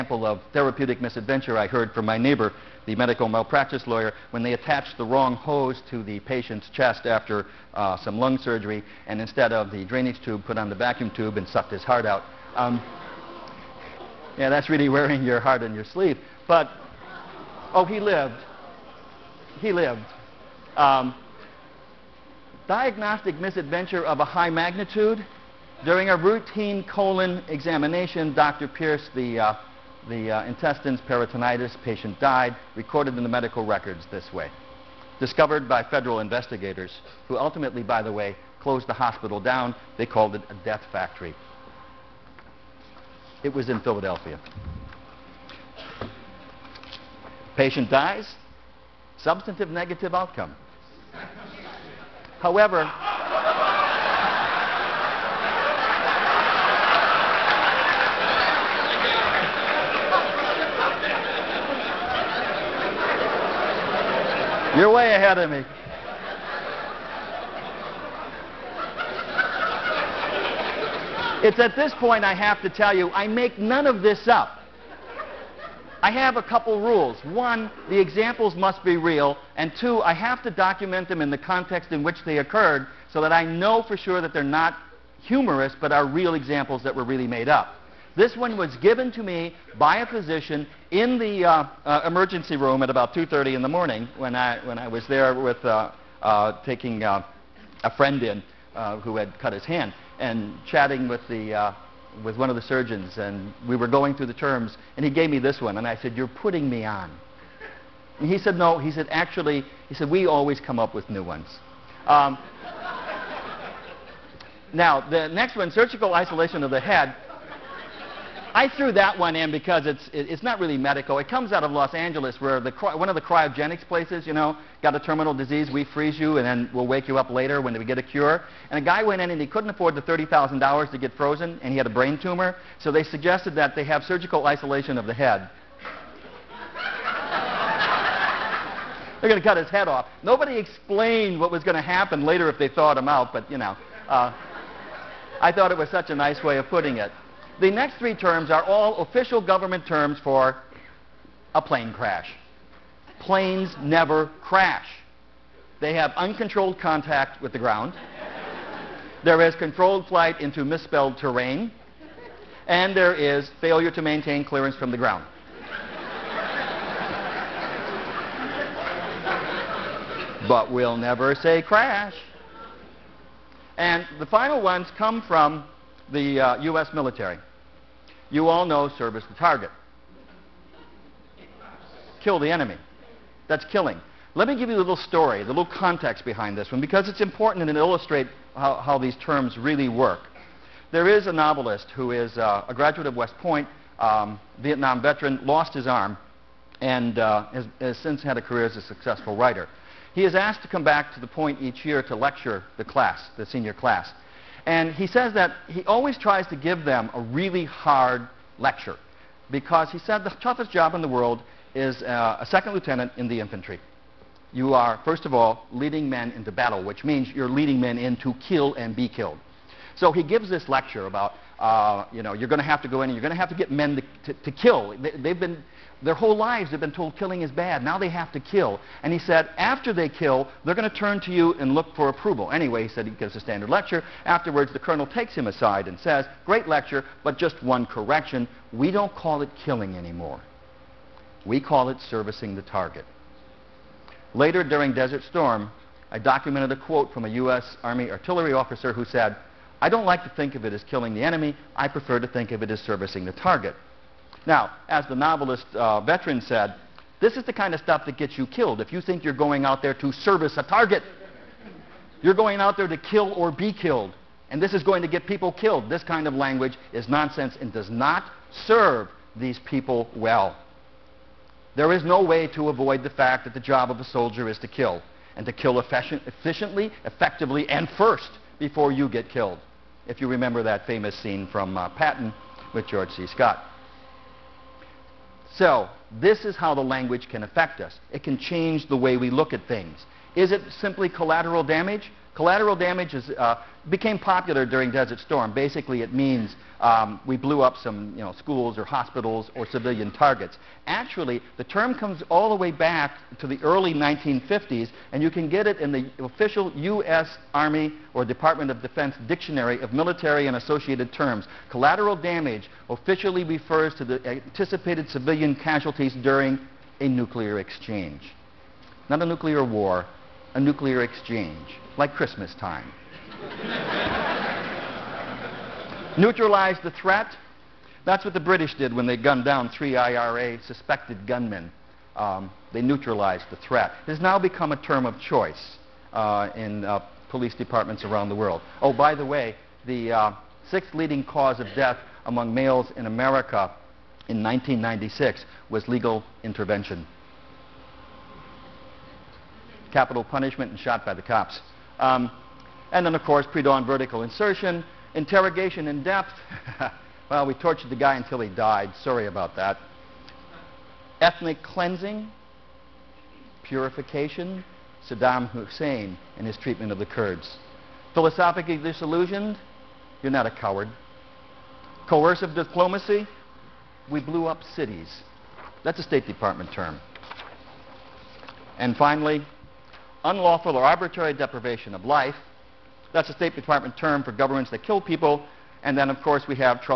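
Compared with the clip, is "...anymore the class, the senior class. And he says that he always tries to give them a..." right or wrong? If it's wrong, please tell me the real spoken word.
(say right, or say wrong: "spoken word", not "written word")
wrong: "lecture", not "anymore".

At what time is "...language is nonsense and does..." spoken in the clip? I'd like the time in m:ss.
4:26.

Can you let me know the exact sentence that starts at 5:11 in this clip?
Collateral damage officially refers to the anticipated civilian casualties during a nuclear exchange.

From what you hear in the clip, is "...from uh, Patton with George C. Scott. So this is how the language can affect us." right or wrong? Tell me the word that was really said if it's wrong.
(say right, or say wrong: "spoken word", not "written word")
right.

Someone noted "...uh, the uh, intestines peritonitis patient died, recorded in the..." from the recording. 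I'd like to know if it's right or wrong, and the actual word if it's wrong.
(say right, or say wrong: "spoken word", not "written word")
right.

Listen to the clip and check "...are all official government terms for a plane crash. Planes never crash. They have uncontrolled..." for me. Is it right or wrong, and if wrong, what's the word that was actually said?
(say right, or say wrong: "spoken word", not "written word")
right.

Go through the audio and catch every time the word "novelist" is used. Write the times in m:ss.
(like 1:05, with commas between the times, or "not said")
3:11, 4:15.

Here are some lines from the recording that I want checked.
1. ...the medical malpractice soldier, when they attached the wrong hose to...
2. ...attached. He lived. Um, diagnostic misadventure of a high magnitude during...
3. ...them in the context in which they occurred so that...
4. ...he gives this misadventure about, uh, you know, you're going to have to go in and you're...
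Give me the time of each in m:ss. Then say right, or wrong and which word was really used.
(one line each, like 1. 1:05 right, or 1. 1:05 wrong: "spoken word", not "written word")
1. 0:02 wrong: "lawyer", not "soldier"
2. 0:18 wrong: "lived", not "attached"
3. 1:21 right
4. 3:40 wrong: "lecture", not "misadventure".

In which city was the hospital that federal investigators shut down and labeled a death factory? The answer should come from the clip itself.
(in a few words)
Philadelphia.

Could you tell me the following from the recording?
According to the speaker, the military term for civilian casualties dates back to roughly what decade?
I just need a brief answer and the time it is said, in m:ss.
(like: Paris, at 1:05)
early 1950s, at 5:03.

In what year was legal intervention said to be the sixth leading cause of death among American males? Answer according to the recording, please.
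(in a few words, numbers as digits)
1996.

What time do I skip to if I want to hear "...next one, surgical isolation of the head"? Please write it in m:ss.
1:55.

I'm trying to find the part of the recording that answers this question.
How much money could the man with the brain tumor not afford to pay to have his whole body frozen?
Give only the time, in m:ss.
2:10.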